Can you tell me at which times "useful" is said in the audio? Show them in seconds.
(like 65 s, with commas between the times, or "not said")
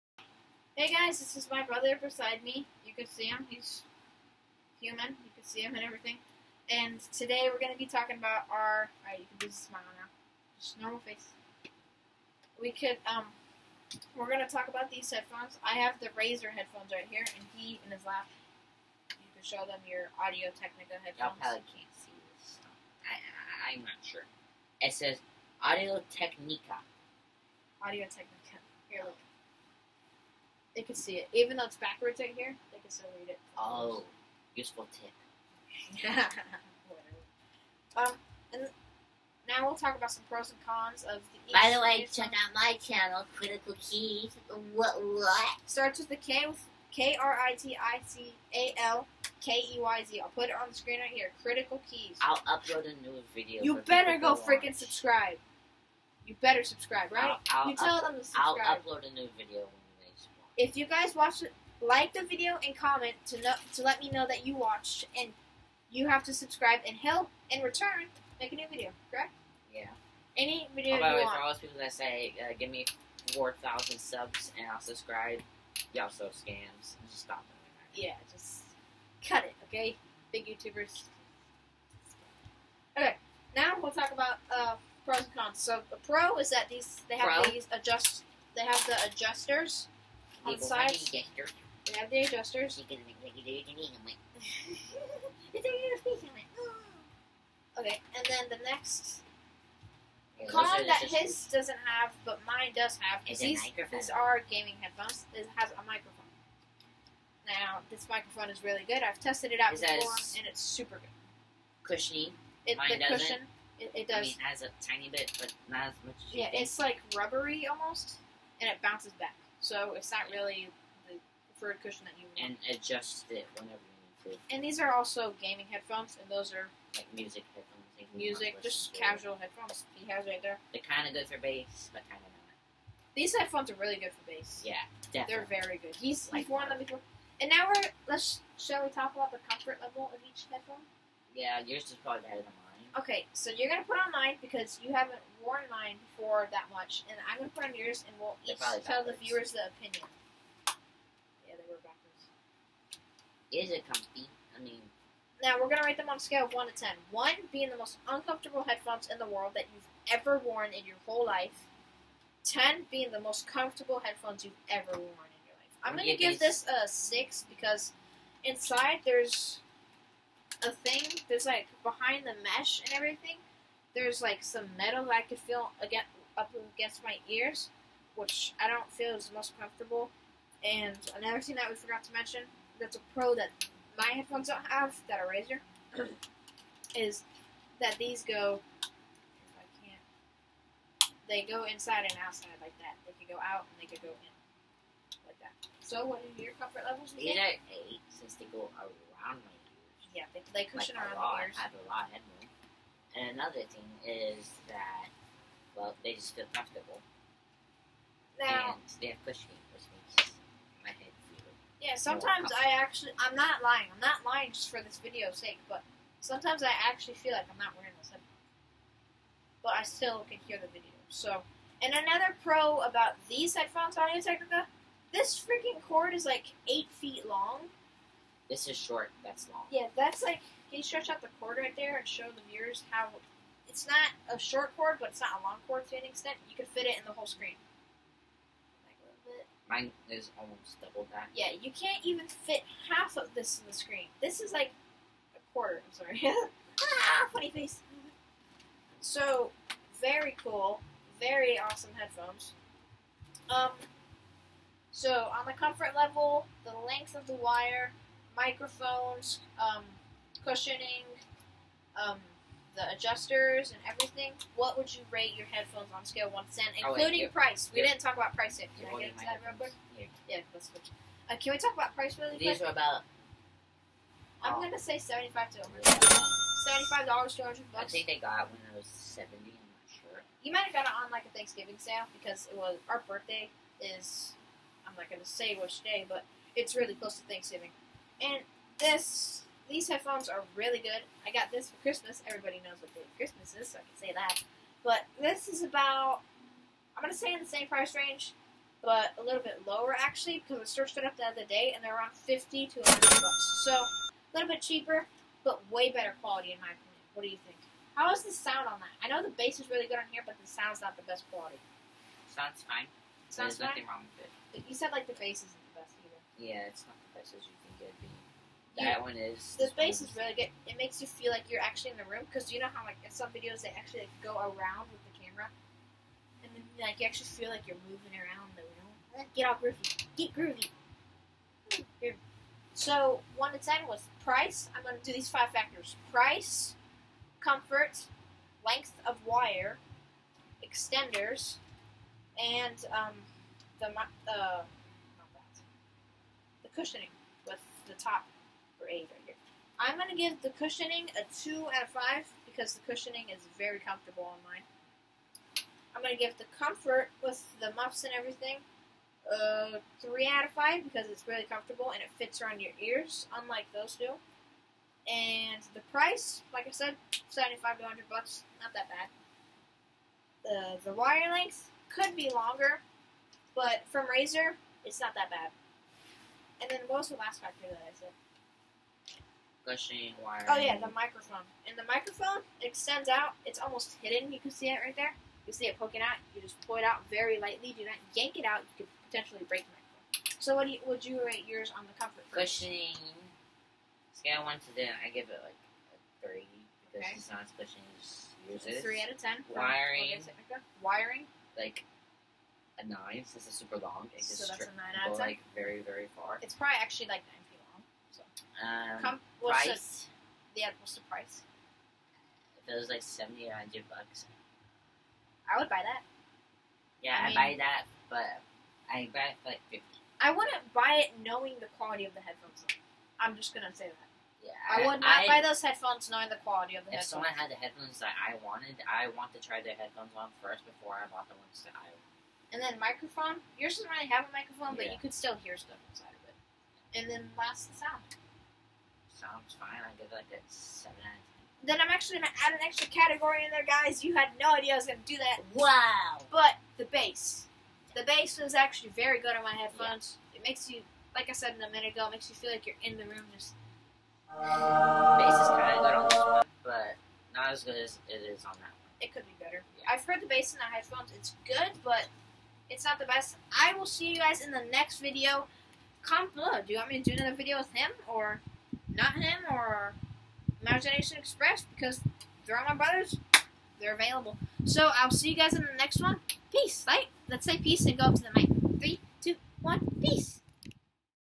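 34 s.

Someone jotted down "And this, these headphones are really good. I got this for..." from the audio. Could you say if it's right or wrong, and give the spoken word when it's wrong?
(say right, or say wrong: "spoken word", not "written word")
right.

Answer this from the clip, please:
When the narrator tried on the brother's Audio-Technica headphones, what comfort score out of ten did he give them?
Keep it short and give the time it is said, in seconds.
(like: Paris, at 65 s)
6, at 166 s.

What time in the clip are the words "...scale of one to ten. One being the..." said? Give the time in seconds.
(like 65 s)
156 s.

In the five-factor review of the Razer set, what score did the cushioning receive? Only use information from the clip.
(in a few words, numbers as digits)
2 out of 5.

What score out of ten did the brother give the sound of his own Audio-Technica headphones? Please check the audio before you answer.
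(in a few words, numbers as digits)
7.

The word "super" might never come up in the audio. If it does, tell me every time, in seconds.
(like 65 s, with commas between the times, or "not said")
110 s, 403 s.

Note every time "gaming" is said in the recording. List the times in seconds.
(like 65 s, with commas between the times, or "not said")
104 s, 125 s.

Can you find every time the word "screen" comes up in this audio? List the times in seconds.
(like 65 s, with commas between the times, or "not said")
50 s, 237 s, 243 s.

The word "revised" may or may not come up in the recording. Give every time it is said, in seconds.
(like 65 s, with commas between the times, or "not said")
not said.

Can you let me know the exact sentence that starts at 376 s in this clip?
And then what was the last factor that I said?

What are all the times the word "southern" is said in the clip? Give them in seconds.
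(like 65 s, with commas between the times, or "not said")
not said.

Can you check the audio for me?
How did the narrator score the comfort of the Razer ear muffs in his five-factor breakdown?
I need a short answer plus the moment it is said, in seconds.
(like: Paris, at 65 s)
3 out of 5, at 360 s.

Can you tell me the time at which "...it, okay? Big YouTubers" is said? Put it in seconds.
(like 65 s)
79 s.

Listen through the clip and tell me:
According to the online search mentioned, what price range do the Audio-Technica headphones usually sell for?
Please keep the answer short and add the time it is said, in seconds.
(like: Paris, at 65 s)
$50 to $100, at 302 s.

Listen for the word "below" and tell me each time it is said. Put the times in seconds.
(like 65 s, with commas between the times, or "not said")
466 s.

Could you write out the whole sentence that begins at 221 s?
So, and another pro about these headphones, Audio Technica, this freaking cord is like eight feet long this is short.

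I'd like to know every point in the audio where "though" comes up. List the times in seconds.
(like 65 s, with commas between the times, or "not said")
31 s, 422 s.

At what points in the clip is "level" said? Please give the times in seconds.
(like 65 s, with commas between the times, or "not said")
139 s, 196 s, 255 s.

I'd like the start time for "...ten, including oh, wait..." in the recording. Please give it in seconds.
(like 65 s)
266 s.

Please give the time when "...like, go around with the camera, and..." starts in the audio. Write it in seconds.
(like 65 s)
324 s.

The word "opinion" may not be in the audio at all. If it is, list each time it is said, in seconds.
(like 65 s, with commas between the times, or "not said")
149 s, 306 s.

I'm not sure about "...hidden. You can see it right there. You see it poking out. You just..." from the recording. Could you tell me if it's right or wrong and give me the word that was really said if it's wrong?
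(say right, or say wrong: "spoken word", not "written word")
right.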